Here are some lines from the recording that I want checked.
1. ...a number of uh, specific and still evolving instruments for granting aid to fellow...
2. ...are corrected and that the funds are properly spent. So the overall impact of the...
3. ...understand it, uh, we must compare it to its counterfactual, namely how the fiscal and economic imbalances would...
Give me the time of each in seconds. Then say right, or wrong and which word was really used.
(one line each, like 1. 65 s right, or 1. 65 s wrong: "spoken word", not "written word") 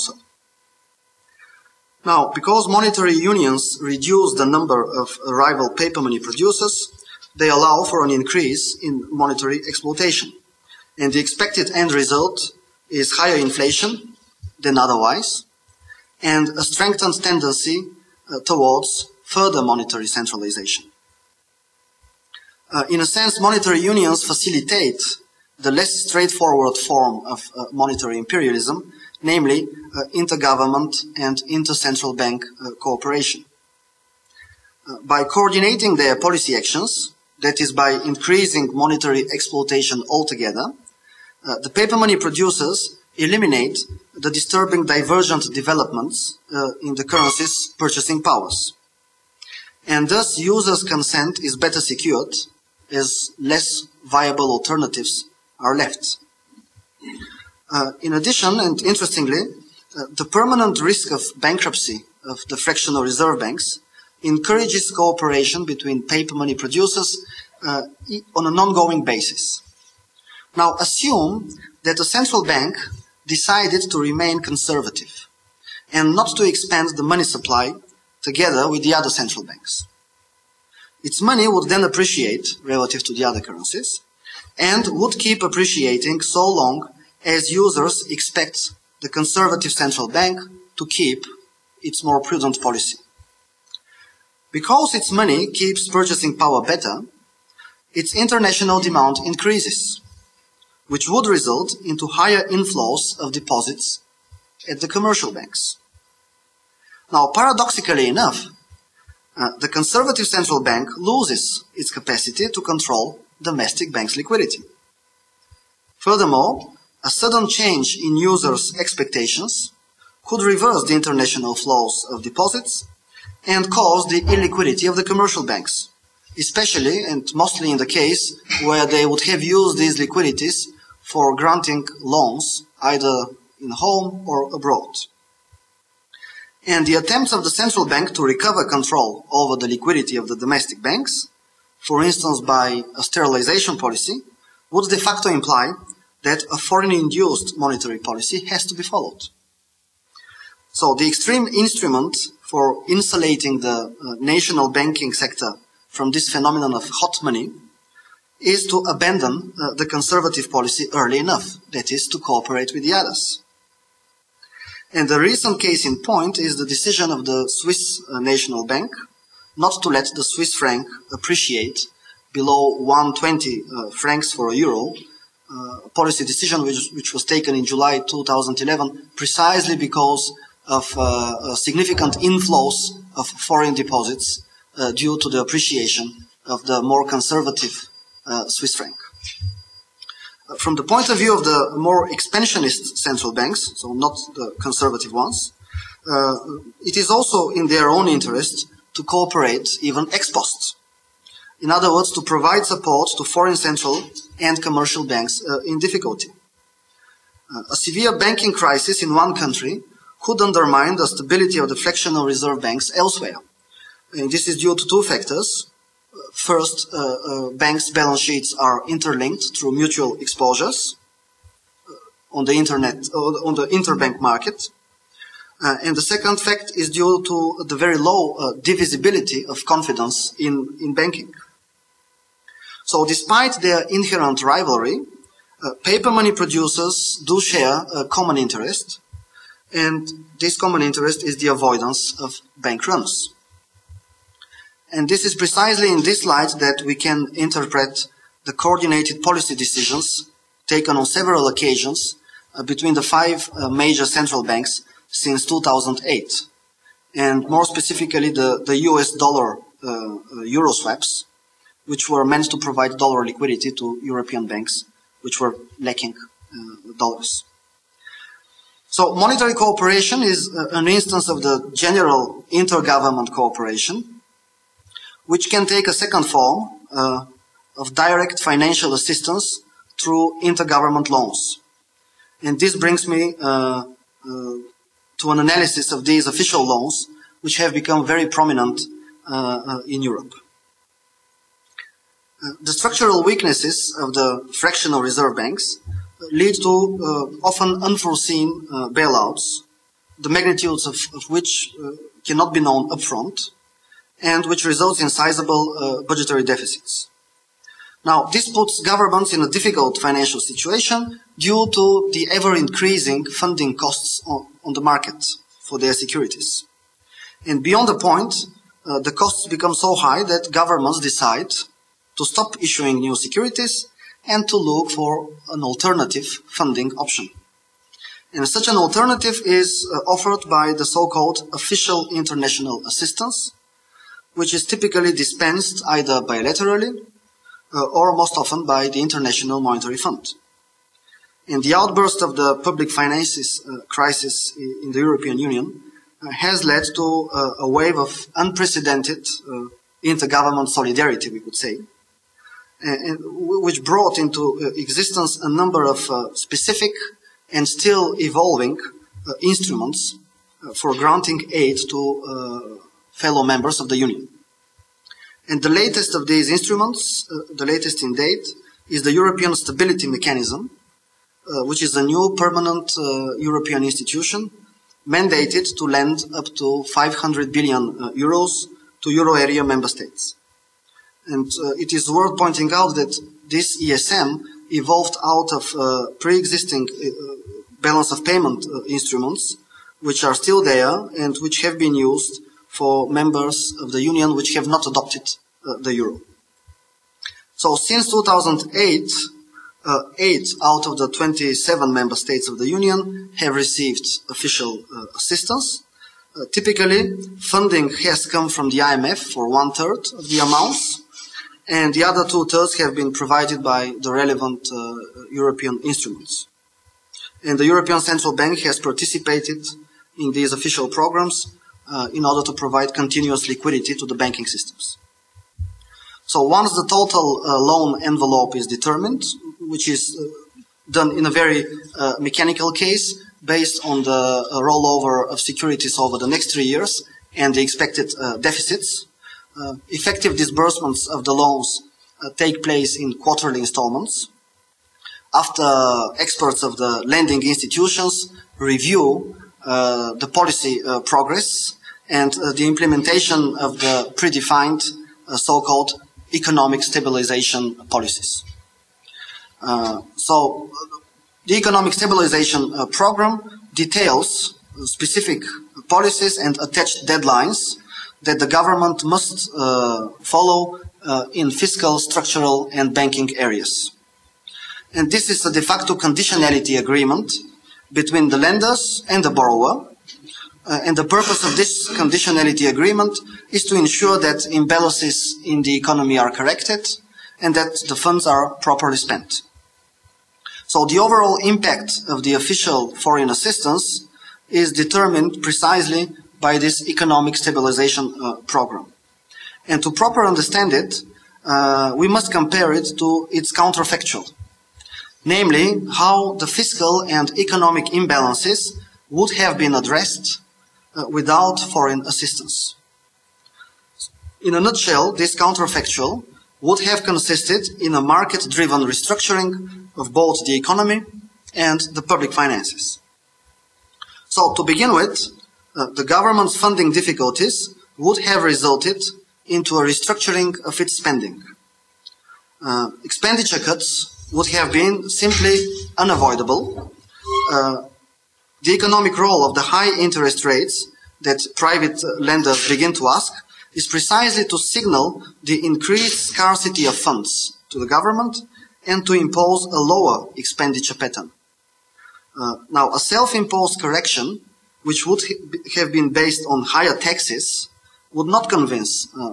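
1. 355 s right
2. 486 s right
3. 500 s right.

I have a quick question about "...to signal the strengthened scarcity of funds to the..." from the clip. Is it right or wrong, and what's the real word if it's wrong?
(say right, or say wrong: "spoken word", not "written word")
wrong: "increased", not "strengthened".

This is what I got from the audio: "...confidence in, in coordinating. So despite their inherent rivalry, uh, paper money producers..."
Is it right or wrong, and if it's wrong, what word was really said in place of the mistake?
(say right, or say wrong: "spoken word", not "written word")
wrong: "banking", not "coordinating".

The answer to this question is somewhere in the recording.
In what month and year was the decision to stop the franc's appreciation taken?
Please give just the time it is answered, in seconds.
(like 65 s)
177 s.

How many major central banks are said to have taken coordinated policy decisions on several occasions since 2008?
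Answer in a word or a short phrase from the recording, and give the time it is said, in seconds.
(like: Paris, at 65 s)
5, at 253 s.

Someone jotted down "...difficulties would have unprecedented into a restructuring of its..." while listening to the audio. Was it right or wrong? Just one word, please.
wrong.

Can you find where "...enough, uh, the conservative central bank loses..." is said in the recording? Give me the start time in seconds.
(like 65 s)
108 s.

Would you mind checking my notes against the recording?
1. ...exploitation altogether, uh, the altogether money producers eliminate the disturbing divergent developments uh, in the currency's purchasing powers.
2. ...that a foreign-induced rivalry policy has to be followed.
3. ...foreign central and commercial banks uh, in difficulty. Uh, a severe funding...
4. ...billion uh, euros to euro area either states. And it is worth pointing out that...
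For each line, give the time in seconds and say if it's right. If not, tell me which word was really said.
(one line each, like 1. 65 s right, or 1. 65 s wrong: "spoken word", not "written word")
1. 39 s wrong: "paper", not "altogether"
2. 146 s wrong: "monetary", not "rivalry"
3. 203 s wrong: "banking", not "funding"
4. 377 s wrong: "member", not "either".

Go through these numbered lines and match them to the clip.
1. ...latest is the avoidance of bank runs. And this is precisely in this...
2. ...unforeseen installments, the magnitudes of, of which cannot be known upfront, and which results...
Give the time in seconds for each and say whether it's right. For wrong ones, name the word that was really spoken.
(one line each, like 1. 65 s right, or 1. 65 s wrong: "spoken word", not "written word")
1. 240 s wrong: "interest", not "latest"
2. 297 s wrong: "bailouts", not "installments".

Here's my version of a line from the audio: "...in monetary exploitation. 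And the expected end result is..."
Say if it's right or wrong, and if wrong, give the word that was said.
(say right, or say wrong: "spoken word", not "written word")
right.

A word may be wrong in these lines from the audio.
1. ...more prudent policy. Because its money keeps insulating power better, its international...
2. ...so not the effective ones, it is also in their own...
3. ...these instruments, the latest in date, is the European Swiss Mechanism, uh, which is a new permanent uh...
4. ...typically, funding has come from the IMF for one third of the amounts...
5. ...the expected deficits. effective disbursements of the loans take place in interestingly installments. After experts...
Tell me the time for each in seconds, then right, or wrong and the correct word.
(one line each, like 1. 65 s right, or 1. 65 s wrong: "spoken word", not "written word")
1. 92 s wrong: "purchasing", not "insulating"
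2. 193 s wrong: "conservative", not "effective"
3. 366 s wrong: "Stability", not "Swiss"
4. 406 s right
5. 437 s wrong: "quarterly", not "interestingly".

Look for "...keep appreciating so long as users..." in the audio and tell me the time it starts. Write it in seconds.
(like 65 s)
85 s.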